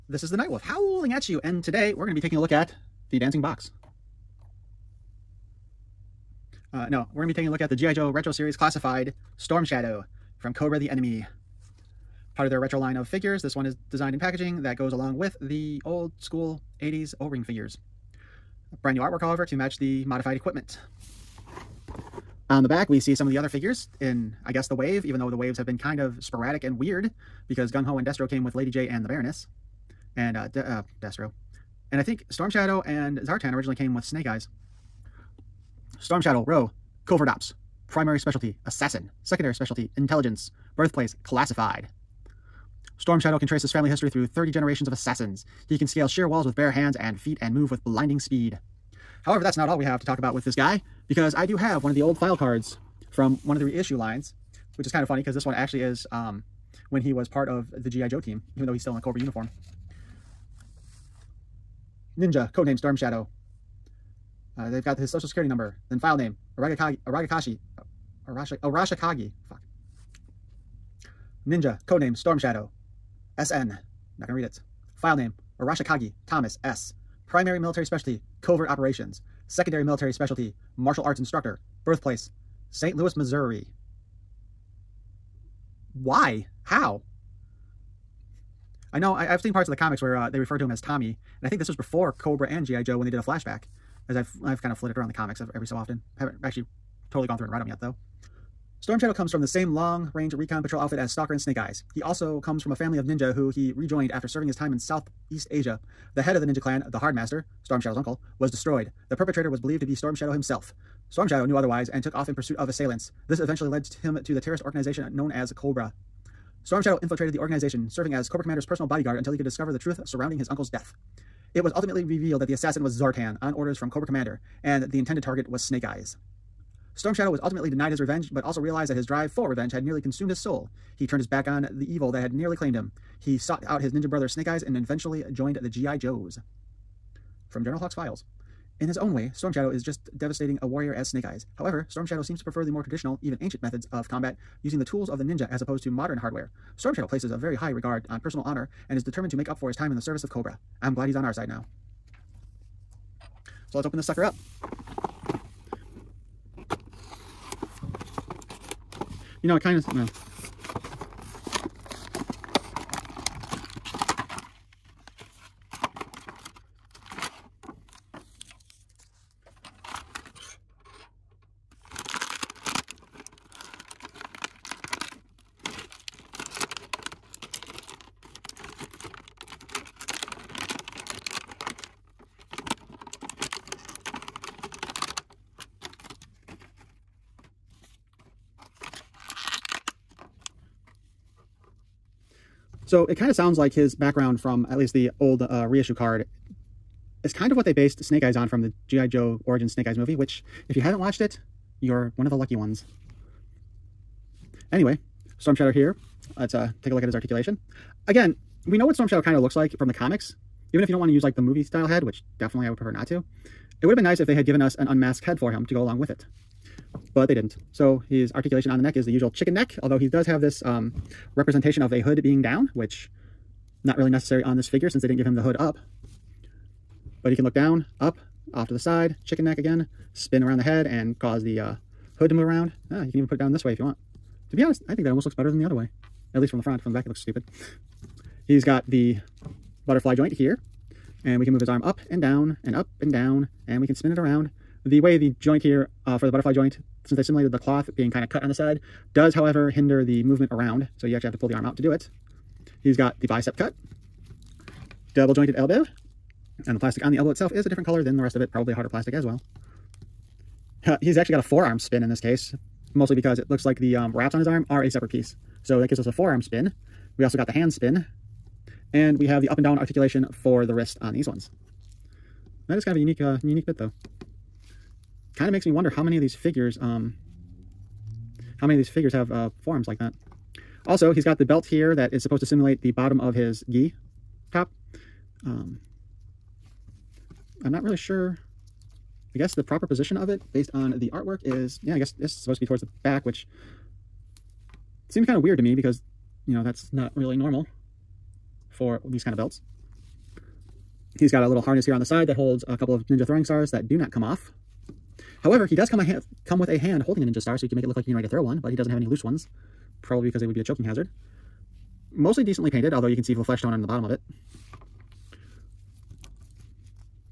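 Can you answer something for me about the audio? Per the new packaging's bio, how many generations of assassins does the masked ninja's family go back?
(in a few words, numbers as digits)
30.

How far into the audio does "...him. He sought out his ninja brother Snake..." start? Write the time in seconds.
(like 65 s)
132 s.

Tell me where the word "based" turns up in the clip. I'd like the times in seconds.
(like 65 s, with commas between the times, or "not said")
197 s, 290 s.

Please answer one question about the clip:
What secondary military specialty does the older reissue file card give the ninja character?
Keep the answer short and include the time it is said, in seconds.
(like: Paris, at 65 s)
Martial arts instructor, at 80 s.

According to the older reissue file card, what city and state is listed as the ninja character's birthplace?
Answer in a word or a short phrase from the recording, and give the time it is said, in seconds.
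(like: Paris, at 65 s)
St. Louis, Missouri, at 82 s.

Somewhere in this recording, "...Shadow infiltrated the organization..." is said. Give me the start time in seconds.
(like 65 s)
116 s.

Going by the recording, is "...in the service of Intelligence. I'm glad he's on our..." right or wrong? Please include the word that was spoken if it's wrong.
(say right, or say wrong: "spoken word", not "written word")
wrong: "Cobra", not "Intelligence".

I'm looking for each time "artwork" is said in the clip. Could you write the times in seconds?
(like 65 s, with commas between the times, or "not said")
18 s, 291 s.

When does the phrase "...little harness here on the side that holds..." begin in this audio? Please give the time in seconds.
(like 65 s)
301 s.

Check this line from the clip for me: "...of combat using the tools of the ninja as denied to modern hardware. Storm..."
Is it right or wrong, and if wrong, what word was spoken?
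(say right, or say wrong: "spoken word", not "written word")
wrong: "opposed", not "denied".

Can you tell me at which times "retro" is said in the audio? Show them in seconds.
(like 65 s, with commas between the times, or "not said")
8 s, 12 s.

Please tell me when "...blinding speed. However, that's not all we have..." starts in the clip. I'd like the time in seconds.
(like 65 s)
47 s.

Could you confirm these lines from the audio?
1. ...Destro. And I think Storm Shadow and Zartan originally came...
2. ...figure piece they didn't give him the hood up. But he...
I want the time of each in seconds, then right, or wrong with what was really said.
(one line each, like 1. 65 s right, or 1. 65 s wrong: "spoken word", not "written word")
1. 31 s right
2. 224 s wrong: "since", not "piece".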